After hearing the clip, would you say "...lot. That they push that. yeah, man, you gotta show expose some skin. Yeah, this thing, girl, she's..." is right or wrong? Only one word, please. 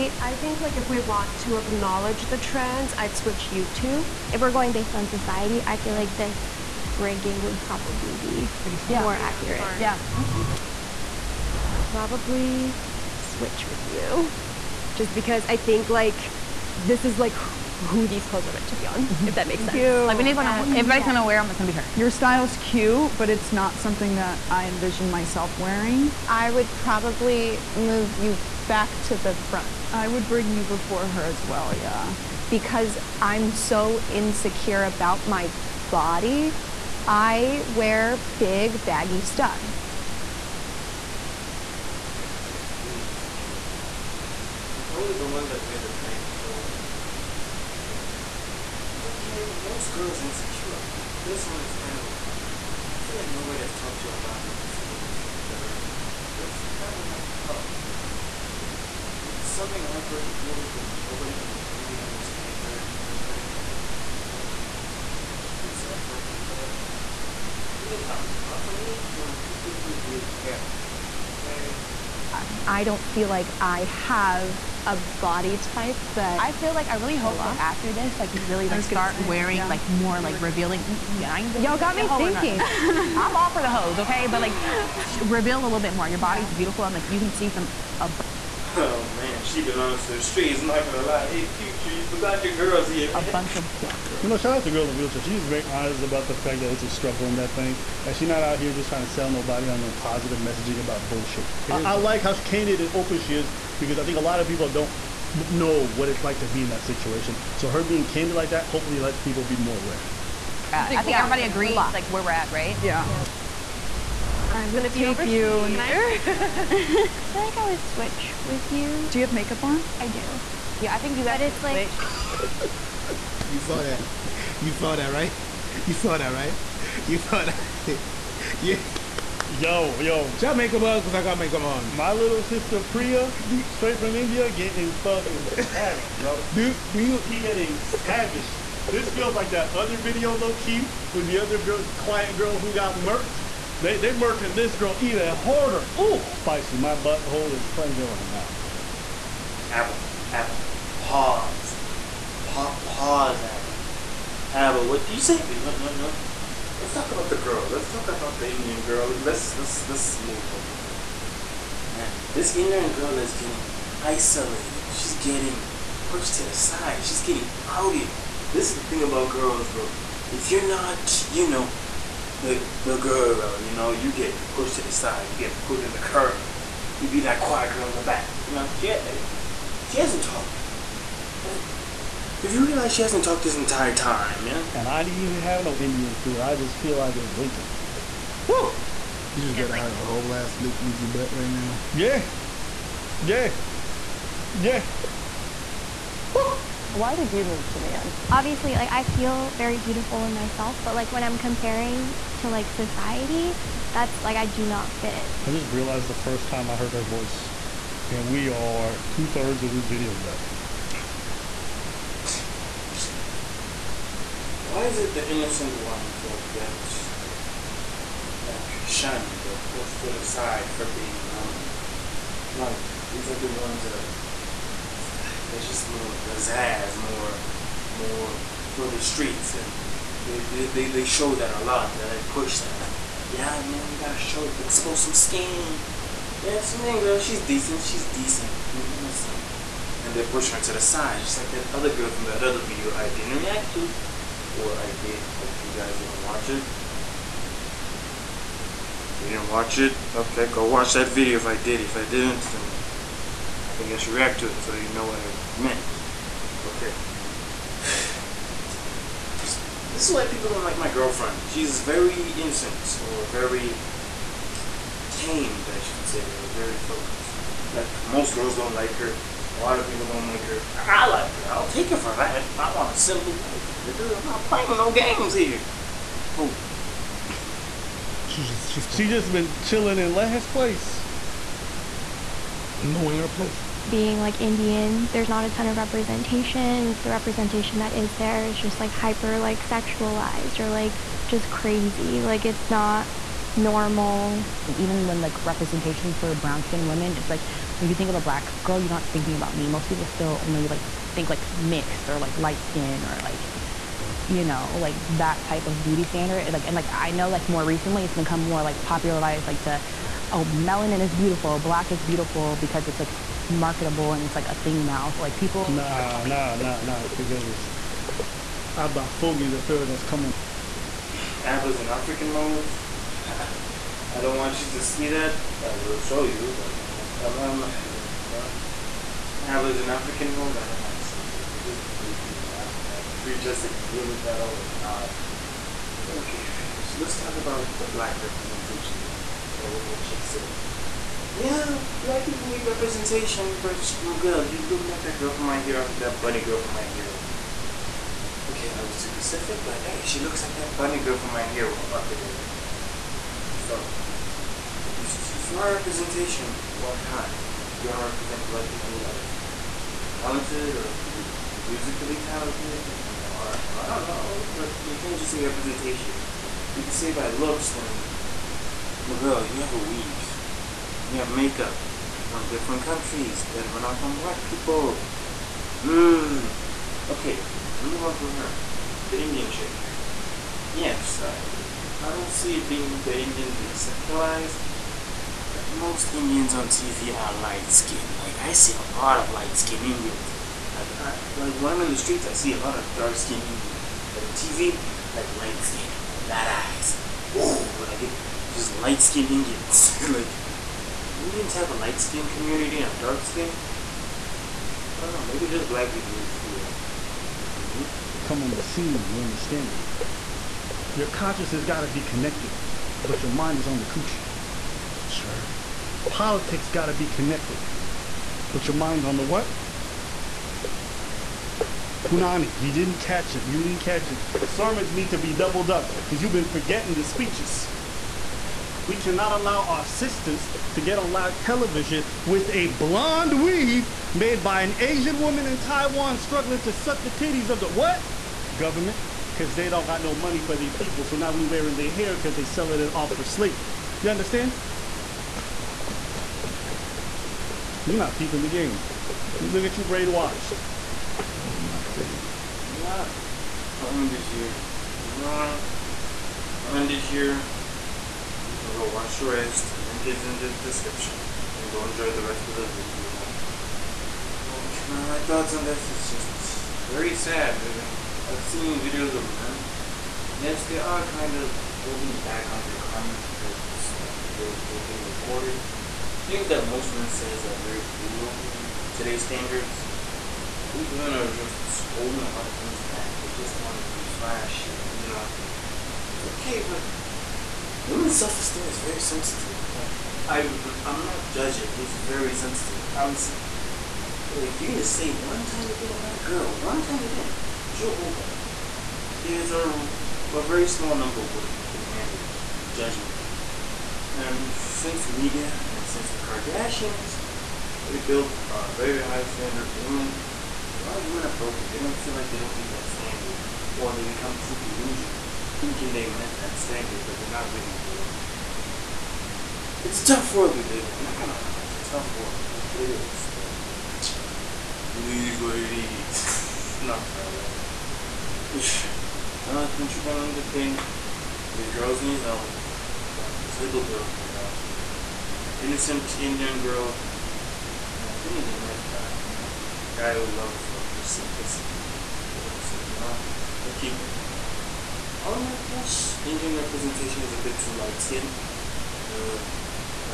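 right.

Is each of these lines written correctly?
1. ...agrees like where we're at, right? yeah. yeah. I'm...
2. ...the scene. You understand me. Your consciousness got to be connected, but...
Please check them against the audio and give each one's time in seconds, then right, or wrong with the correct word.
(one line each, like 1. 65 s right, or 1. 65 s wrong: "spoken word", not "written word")
1. 111 s right
2. 408 s right.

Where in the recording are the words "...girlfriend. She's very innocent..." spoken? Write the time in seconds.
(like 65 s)
260 s.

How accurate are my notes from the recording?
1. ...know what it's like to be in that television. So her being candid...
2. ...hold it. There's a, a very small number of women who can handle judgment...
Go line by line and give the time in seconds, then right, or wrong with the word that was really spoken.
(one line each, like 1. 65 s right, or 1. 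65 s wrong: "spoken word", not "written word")
1. 105 s wrong: "situation", not "television"
2. 497 s right.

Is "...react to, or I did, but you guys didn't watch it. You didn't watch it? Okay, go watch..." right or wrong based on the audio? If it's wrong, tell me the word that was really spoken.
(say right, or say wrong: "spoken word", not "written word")
right.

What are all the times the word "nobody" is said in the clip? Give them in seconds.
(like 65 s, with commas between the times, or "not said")
53 s, 61 s, 99 s.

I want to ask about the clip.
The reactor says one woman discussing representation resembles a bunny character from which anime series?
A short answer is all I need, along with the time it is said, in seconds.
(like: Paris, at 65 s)
My Hero Academia, at 351 s.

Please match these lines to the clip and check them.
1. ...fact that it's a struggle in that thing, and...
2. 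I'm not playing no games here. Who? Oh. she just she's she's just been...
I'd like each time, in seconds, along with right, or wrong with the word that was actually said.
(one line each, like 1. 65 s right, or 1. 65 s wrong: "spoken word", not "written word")
1. 96 s right
2. 274 s right.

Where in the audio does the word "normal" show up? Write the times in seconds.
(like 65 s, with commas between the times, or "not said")
221 s, 293 s.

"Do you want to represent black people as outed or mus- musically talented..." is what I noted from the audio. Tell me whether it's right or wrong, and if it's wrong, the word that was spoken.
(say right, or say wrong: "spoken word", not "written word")
wrong: "talented", not "outed".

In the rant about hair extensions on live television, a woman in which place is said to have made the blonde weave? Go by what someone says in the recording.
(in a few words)
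Taiwan.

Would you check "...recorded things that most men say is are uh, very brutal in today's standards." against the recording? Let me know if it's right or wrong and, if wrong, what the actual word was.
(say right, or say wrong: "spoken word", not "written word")
right.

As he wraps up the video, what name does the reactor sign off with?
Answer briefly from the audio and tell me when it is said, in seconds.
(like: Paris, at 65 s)
Triple N 2 King, at 529 s.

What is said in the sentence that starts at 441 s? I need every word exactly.
So now we wearing their hair because they selling it off for slavery.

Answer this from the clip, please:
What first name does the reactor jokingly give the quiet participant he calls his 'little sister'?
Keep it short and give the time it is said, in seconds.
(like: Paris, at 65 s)
Priya, at 132 s.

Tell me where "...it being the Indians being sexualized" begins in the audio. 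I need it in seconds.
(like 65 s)
382 s.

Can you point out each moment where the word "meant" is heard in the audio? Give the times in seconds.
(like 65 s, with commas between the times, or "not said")
18 s, 255 s.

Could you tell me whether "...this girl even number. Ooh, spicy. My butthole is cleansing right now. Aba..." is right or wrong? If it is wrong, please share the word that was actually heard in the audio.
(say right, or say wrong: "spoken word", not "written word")
wrong: "harder", not "number".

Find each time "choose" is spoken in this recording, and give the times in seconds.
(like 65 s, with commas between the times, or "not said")
not said.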